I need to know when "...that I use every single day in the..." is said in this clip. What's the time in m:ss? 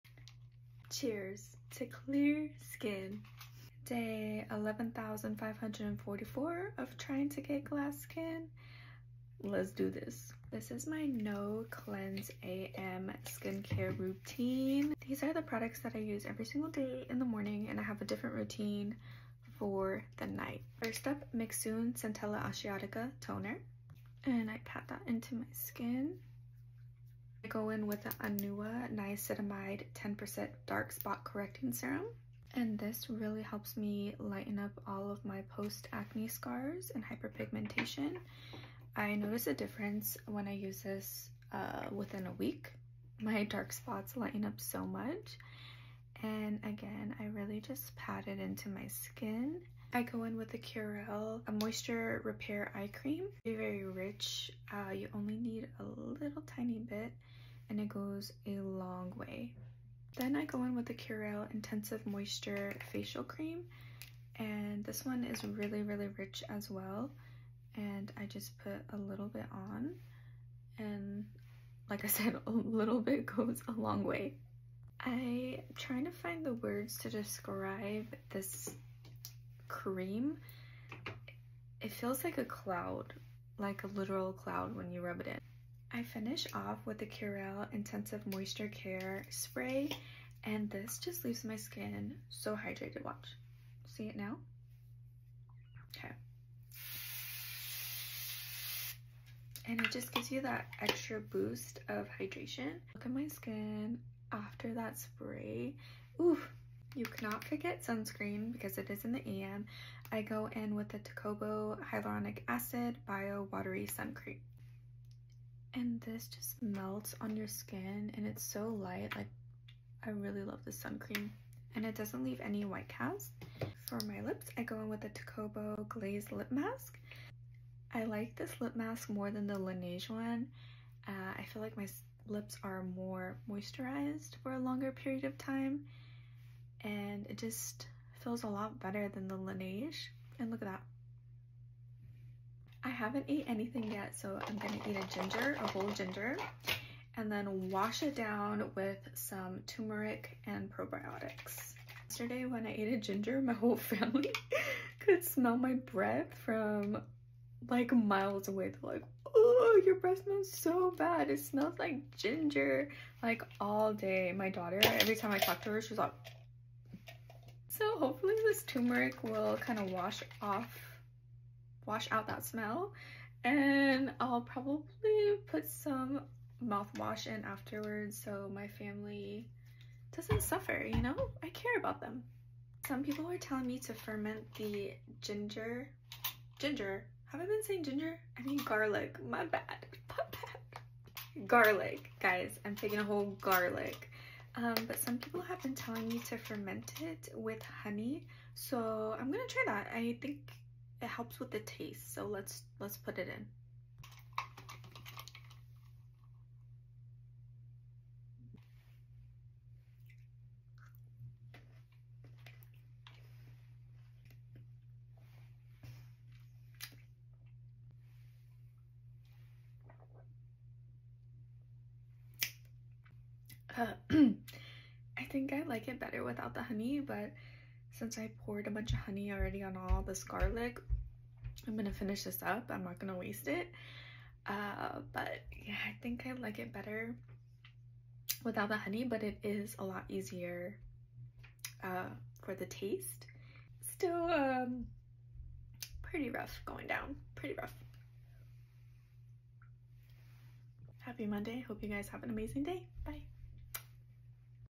0:15.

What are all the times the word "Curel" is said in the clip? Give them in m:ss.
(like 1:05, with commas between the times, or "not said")
0:50, 1:00, 1:27.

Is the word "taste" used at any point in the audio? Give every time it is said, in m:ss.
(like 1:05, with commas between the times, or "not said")
3:21, 4:02.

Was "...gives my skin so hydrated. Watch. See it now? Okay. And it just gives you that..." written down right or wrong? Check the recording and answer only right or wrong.
wrong.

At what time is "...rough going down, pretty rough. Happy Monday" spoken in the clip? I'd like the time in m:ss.
4:06.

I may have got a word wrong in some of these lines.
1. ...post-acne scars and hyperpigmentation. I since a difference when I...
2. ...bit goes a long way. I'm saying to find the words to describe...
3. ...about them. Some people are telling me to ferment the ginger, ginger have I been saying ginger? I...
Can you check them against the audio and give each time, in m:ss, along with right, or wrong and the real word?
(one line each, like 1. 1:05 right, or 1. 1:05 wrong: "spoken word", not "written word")
1. 0:35 wrong: "notice", not "since"
2. 1:13 wrong: "trying", not "saying"
3. 3:01 right.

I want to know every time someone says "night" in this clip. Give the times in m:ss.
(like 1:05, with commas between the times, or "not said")
0:20.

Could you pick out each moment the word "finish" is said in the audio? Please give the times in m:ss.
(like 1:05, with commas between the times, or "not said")
1:26, 3:51.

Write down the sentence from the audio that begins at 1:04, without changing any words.
And this one is really, really rich as well.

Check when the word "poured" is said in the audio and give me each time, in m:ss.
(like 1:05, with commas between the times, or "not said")
3:48.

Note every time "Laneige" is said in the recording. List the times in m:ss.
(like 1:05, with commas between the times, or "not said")
2:09, 2:19.